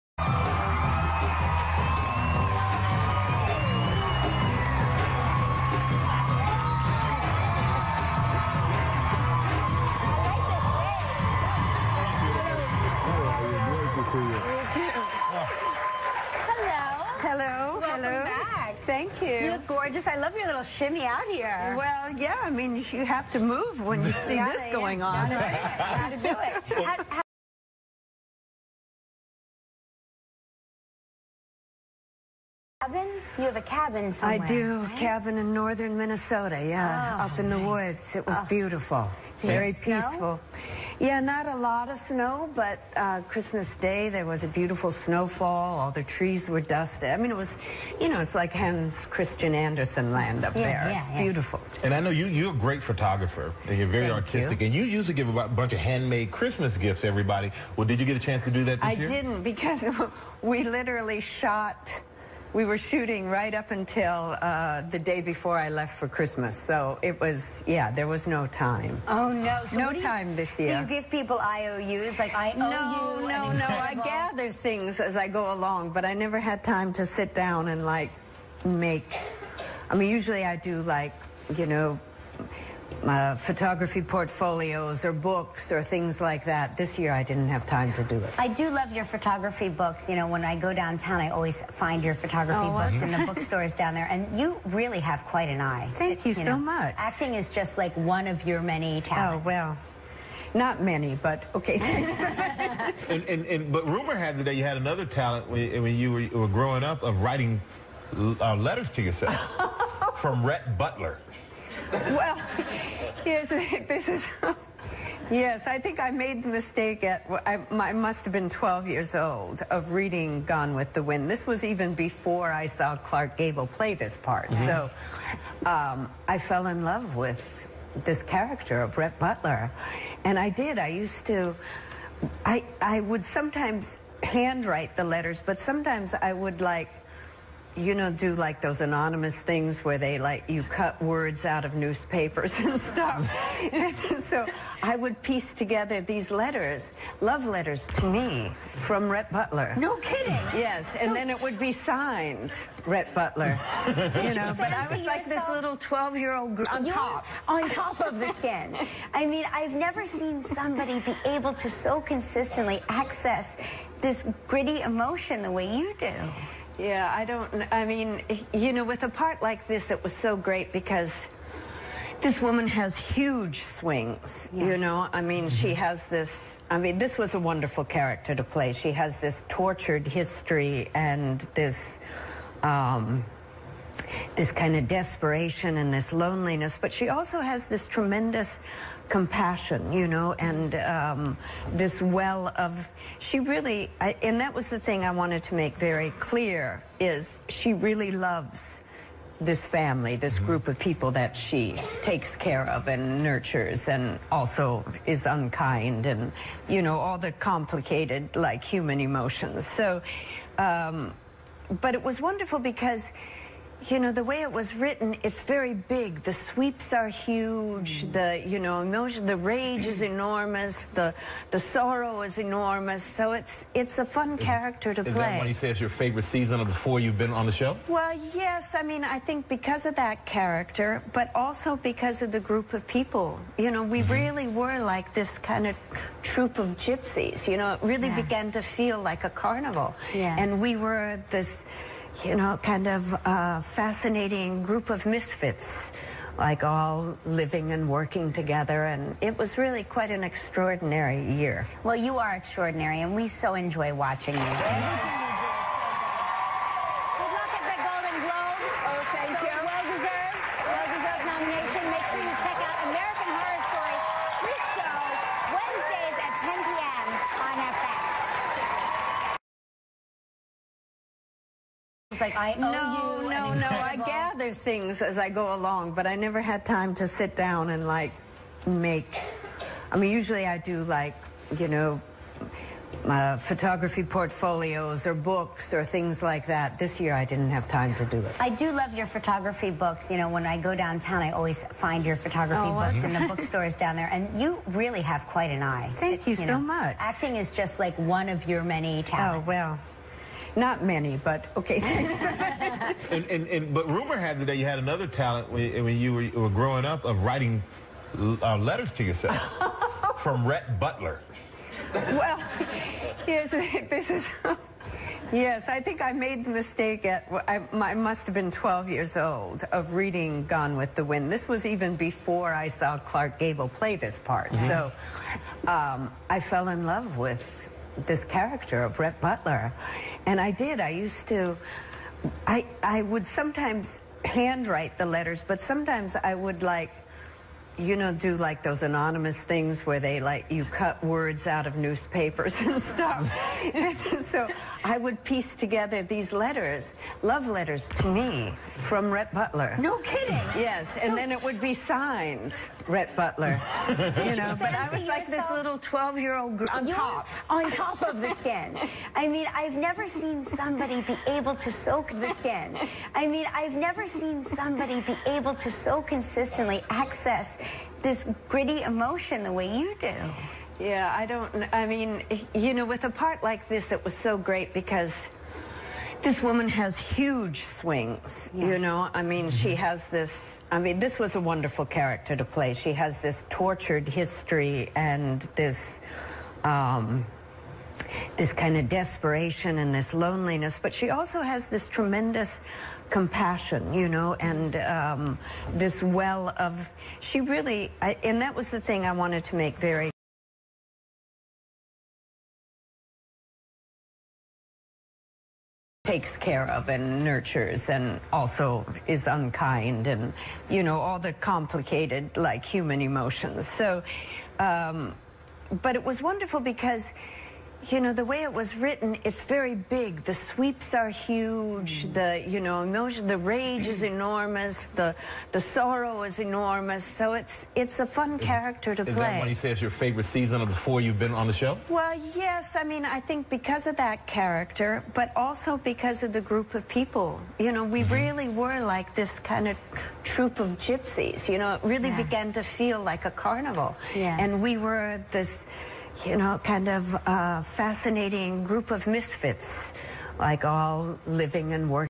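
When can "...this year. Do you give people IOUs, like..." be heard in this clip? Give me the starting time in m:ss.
1:10.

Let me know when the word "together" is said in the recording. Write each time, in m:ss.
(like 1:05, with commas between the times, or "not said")
2:25, 4:08, 5:45.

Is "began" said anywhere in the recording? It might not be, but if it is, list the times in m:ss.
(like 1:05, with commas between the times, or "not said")
3:58, 7:22.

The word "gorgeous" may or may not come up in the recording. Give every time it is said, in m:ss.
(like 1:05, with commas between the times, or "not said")
0:19.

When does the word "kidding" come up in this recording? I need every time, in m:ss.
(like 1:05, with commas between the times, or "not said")
2:29, 5:49.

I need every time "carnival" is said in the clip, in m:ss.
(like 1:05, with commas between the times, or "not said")
3:59, 7:23.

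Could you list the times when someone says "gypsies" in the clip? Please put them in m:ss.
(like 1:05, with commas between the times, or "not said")
3:56, 7:20.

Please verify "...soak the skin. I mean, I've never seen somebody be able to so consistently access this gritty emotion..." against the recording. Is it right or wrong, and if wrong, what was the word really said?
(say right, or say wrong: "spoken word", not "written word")
right.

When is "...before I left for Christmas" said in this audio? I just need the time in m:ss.
1:05.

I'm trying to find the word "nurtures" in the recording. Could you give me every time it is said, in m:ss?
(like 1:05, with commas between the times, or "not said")
3:23, 6:47.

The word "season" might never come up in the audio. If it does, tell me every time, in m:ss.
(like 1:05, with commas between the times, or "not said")
3:46, 7:10.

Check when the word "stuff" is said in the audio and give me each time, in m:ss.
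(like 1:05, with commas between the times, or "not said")
2:22, 5:42.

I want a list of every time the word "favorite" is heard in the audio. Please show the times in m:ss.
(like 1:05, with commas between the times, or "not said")
3:45, 7:09.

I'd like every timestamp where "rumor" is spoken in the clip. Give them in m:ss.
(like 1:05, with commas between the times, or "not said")
1:43, 5:03.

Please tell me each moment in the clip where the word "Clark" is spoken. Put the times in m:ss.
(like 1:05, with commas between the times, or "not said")
2:02, 5:22.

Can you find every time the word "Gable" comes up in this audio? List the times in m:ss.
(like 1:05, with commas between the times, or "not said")
2:03, 5:23.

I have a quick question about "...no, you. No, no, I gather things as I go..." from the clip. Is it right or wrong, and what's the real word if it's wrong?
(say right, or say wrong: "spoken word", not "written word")
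right.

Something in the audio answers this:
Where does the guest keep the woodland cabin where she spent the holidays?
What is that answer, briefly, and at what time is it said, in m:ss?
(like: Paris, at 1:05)
Northern Minnesota, at 0:35.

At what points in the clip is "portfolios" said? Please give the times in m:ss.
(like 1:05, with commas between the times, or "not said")
1:24, 4:44.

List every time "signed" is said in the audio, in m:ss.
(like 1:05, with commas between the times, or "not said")
2:31, 5:51.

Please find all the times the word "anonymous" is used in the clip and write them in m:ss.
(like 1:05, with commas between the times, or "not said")
2:18, 5:38.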